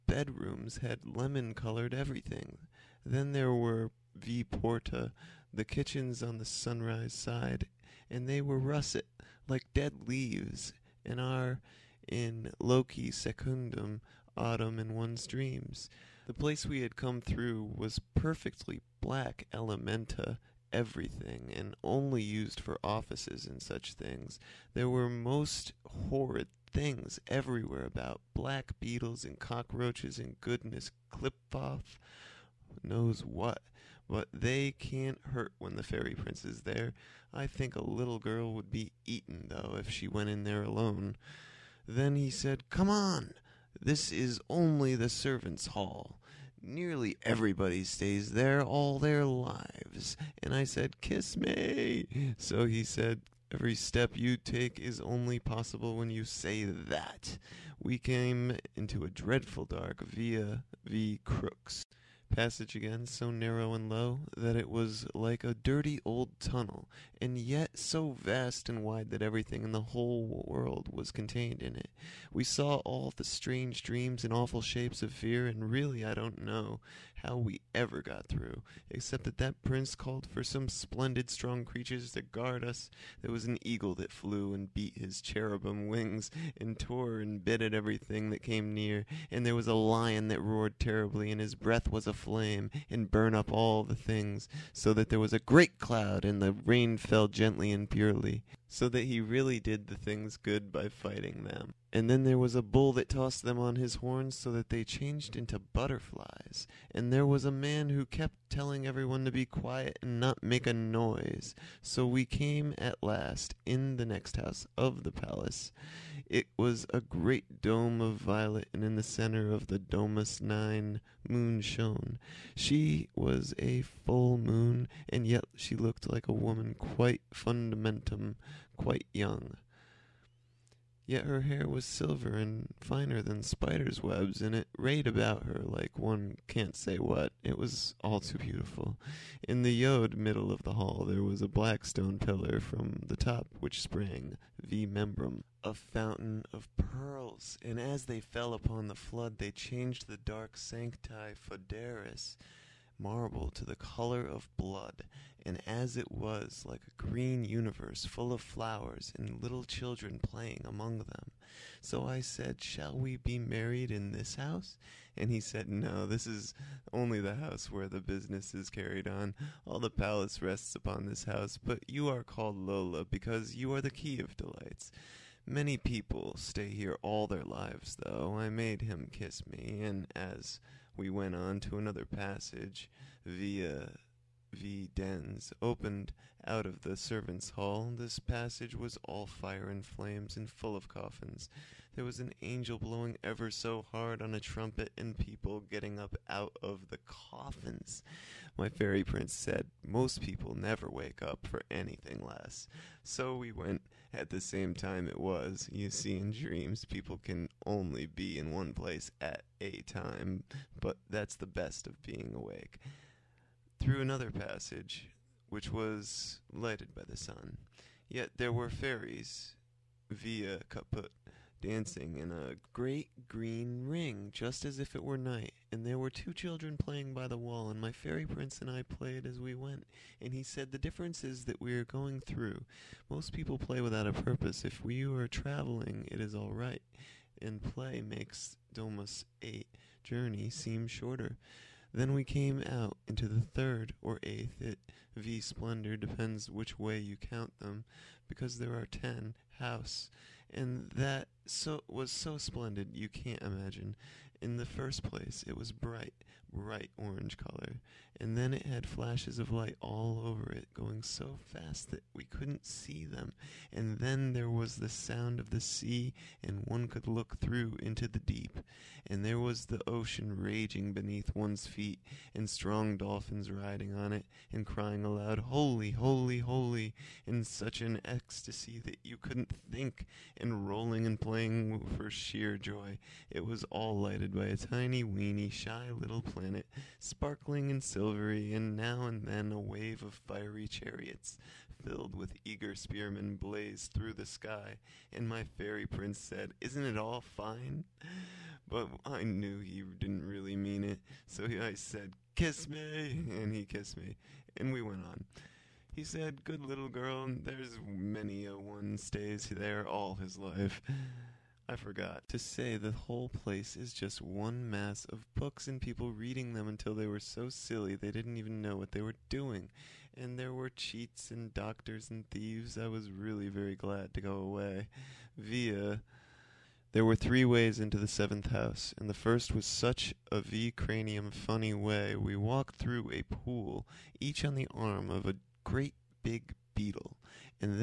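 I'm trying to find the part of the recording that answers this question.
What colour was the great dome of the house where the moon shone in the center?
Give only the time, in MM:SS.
01:58.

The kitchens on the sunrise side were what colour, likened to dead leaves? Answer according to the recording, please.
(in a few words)
russet.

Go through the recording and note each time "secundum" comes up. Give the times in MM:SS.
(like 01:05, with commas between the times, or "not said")
00:13.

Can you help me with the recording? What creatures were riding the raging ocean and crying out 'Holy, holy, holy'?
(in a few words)
dolphins.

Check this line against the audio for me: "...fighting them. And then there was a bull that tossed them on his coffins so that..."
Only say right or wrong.
wrong.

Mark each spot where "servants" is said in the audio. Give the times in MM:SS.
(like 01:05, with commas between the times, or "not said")
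00:45, 03:06.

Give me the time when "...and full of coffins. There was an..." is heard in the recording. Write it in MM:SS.
03:10.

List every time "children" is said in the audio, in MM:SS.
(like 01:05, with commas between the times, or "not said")
02:39, 03:46.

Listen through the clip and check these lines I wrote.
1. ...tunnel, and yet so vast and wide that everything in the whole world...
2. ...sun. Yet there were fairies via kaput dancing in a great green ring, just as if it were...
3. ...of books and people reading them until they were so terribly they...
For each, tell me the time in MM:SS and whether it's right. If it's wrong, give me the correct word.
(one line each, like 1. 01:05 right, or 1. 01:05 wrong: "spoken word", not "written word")
1. 01:06 right
2. 03:37 right
3. 05:15 wrong: "silly", not "terribly".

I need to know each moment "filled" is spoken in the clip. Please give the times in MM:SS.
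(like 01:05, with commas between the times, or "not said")
04:51.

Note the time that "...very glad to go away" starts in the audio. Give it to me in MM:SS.
05:23.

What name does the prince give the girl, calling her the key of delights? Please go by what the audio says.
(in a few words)
Lola.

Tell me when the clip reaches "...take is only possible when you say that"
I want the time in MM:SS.
00:54.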